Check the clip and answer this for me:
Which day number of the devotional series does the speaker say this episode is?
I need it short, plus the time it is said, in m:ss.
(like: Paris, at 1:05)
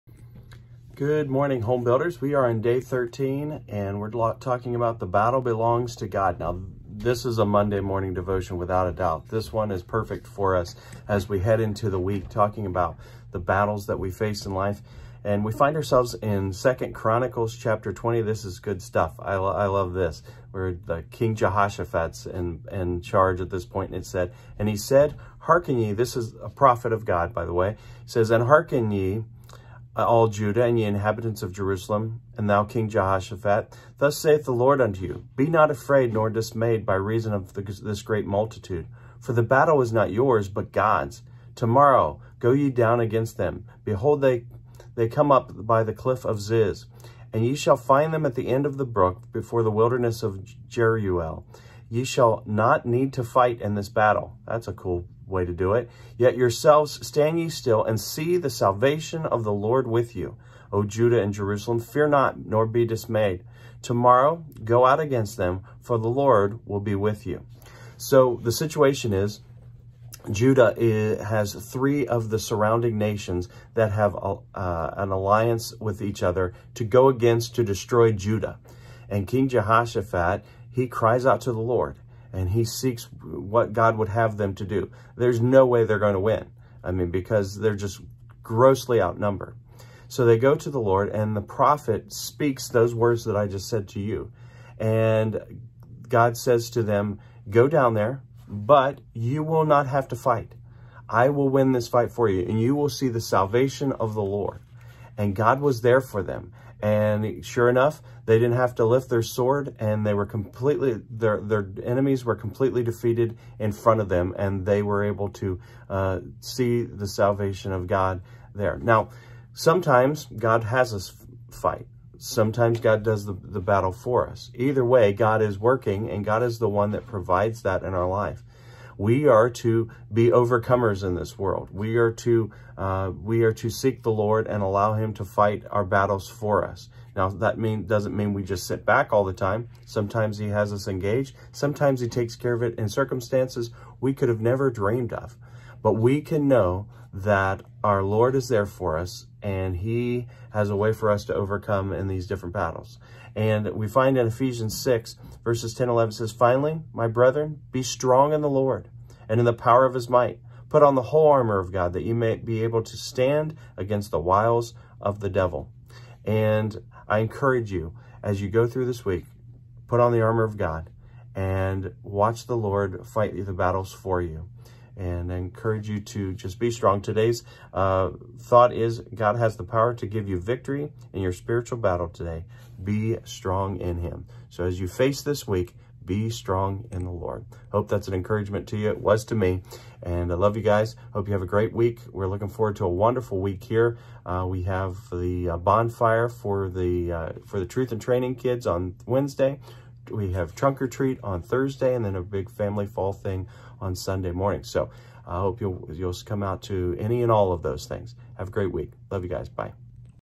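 13, at 0:02.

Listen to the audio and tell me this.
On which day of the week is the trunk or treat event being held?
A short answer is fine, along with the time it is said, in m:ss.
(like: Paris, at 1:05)
Thursday, at 3:21.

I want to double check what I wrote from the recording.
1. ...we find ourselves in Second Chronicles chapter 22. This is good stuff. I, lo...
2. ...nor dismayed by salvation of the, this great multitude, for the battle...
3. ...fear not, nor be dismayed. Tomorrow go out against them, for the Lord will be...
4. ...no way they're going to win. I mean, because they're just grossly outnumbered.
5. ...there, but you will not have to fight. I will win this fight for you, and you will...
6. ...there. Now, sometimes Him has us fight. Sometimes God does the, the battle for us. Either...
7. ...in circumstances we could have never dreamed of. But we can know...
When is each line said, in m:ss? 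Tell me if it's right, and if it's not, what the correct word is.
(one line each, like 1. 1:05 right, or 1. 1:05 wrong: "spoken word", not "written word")
1. 0:15 wrong: "20", not "22"
2. 0:36 wrong: "reason", not "salvation"
3. 1:01 right
4. 1:25 right
5. 1:37 right
6. 1:58 wrong: "God", not "Him"
7. 2:22 right.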